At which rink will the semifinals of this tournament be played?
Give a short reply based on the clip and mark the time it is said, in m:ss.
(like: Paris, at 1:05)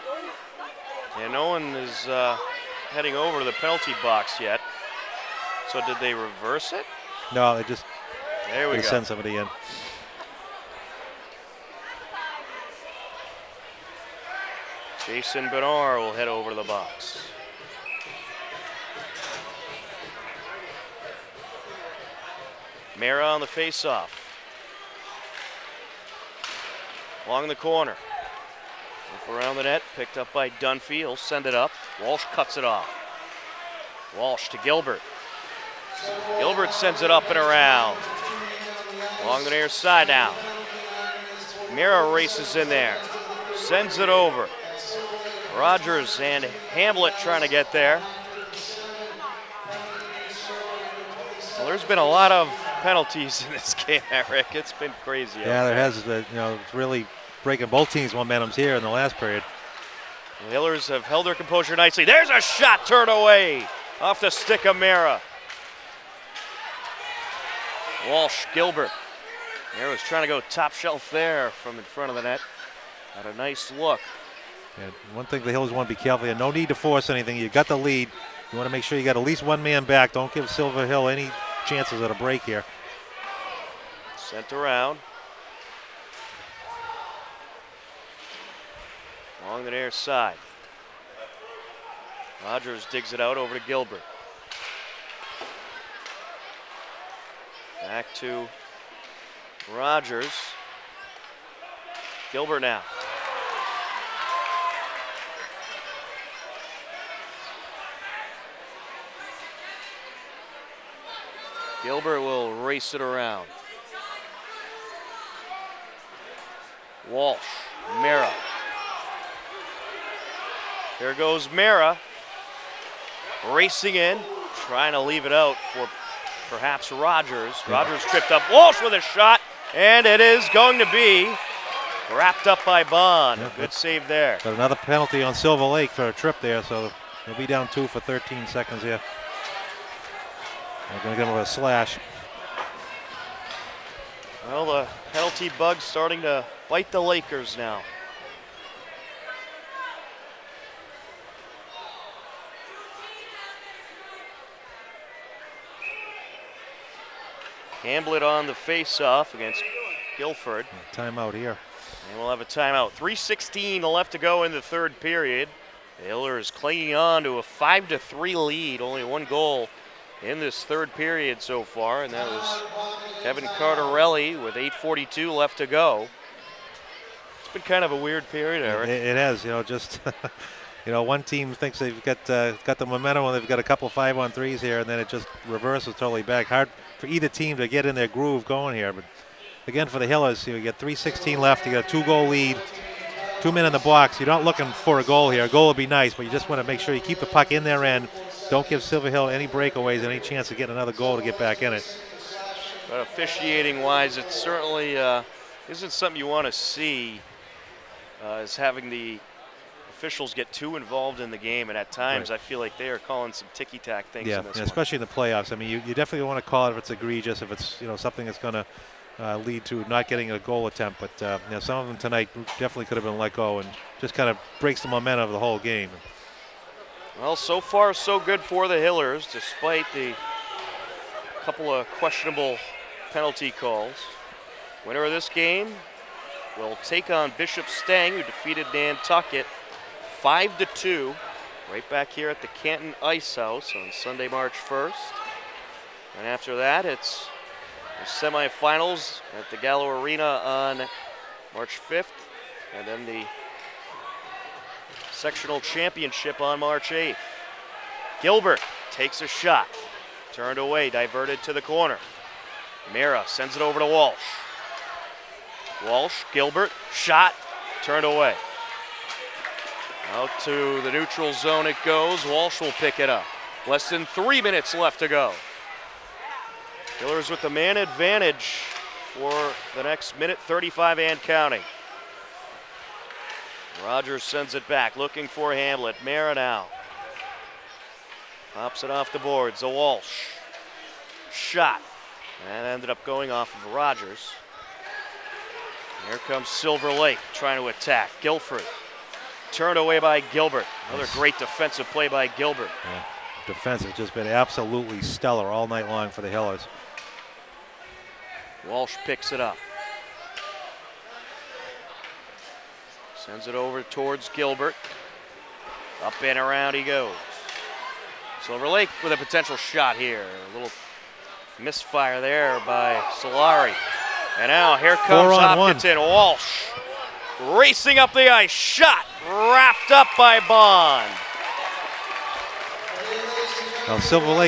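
Gallo Arena, at 4:09.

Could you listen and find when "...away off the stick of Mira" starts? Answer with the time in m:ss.
1:03.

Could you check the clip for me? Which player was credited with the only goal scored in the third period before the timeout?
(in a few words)
Kevin Cardarelli.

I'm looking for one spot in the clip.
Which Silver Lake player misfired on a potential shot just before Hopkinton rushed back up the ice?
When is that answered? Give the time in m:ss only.
5:23.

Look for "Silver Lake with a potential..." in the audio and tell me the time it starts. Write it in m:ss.
5:18.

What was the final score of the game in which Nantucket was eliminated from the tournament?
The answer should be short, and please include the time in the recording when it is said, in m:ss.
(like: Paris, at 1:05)
5 to 2, at 4:00.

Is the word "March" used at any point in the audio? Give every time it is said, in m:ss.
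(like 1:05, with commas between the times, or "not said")
4:04, 4:11, 4:16.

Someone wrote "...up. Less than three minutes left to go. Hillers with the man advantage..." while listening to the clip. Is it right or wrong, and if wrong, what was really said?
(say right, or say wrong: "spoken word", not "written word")
right.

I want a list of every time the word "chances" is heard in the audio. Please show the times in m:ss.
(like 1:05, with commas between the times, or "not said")
1:21, 3:20.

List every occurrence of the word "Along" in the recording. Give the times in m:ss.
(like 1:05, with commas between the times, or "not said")
0:27, 0:39, 1:29.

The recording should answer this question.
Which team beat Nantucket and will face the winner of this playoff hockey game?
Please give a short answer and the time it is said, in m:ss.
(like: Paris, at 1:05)
Bishop Stang, at 3:57.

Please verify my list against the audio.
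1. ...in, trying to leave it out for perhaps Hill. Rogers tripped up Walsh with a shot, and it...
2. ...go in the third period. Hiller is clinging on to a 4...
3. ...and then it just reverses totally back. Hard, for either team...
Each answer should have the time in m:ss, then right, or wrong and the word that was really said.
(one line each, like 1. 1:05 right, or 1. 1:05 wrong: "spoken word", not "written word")
1. 2:03 wrong: "Rogers", not "Hill"
2. 2:44 wrong: "5", not "4"
3. 3:04 right.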